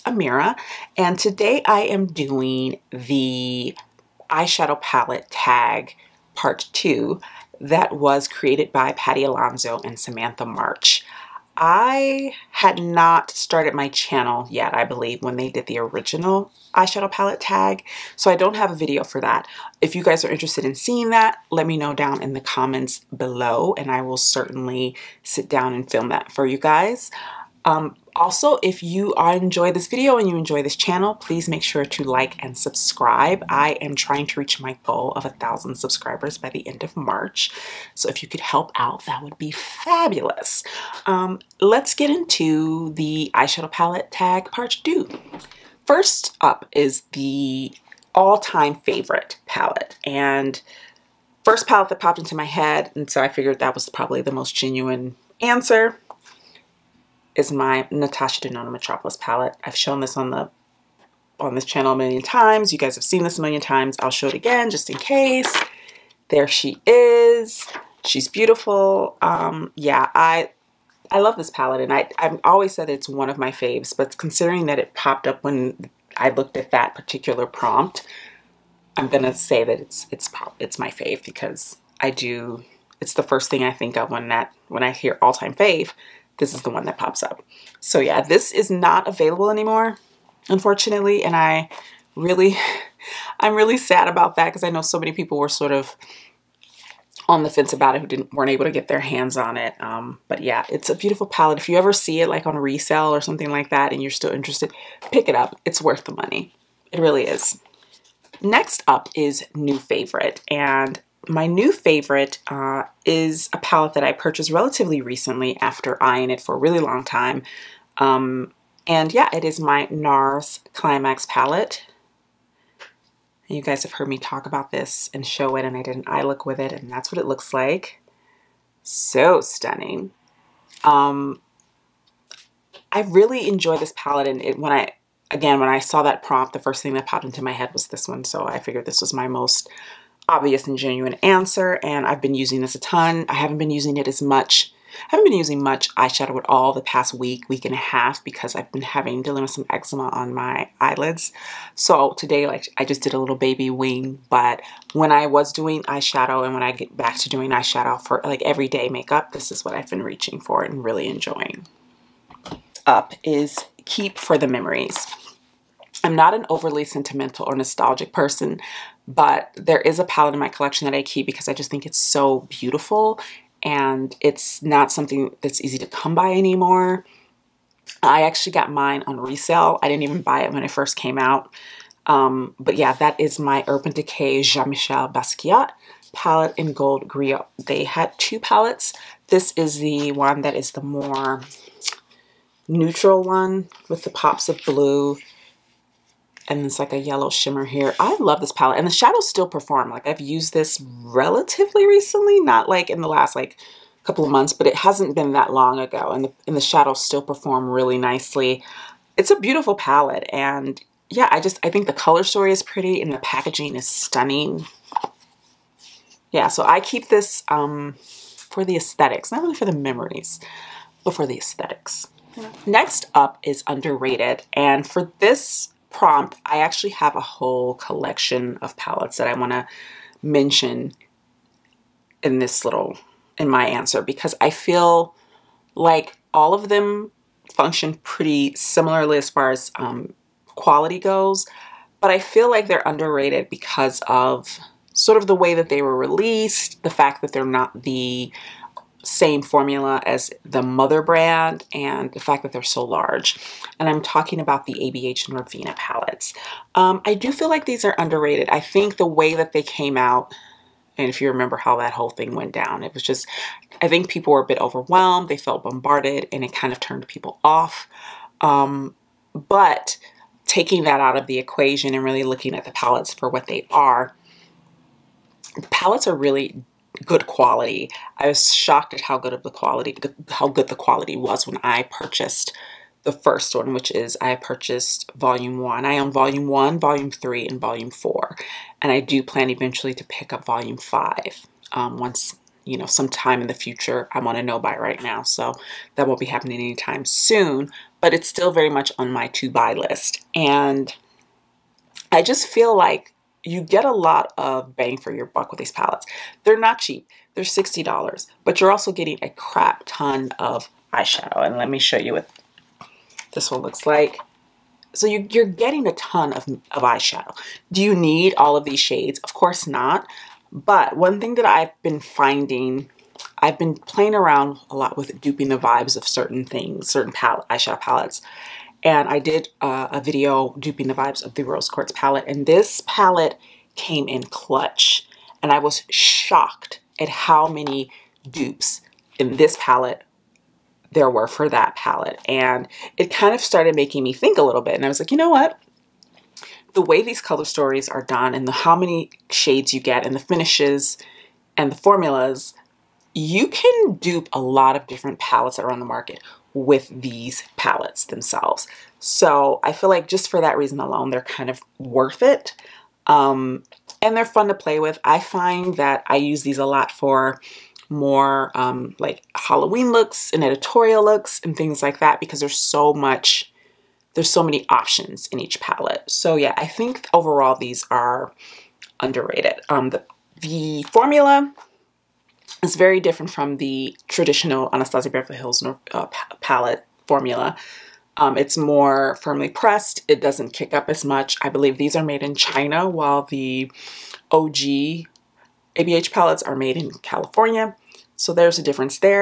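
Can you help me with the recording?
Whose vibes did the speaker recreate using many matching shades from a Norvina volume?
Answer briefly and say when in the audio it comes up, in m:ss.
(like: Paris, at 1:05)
Rose Quartz, at 5:31.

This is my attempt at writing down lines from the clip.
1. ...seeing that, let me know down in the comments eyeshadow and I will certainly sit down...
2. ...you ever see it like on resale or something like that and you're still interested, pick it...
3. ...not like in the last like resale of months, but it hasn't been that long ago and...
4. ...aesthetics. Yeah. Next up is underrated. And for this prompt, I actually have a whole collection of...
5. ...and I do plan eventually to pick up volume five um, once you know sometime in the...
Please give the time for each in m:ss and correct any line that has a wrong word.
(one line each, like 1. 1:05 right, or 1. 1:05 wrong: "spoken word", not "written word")
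1. 0:20 wrong: "below", not "eyeshadow"
2. 1:41 right
3. 3:22 wrong: "couple", not "resale"
4. 3:41 right
5. 4:48 right.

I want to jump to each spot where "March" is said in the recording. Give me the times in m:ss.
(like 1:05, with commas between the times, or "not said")
0:10, 0:36.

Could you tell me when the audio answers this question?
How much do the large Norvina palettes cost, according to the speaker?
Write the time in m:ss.
5:07.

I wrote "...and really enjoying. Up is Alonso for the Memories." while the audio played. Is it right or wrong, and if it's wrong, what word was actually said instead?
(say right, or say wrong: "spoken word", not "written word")
wrong: "Keep", not "Alonso".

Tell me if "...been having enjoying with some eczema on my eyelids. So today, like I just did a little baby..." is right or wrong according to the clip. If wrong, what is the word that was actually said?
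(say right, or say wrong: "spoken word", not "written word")
wrong: "dealing", not "enjoying".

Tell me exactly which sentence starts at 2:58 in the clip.
I actually got mine on resale.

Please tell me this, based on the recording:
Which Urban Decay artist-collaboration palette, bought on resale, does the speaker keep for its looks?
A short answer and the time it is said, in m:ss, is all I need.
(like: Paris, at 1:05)
Gold Griot, at 3:06.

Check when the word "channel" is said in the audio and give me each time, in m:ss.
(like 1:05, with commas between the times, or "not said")
0:13, 0:30, 1:01.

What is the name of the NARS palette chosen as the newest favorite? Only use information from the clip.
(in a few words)
Climax.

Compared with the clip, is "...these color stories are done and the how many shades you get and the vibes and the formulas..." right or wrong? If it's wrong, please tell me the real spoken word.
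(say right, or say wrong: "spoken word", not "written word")
wrong: "finishes", not "vibes".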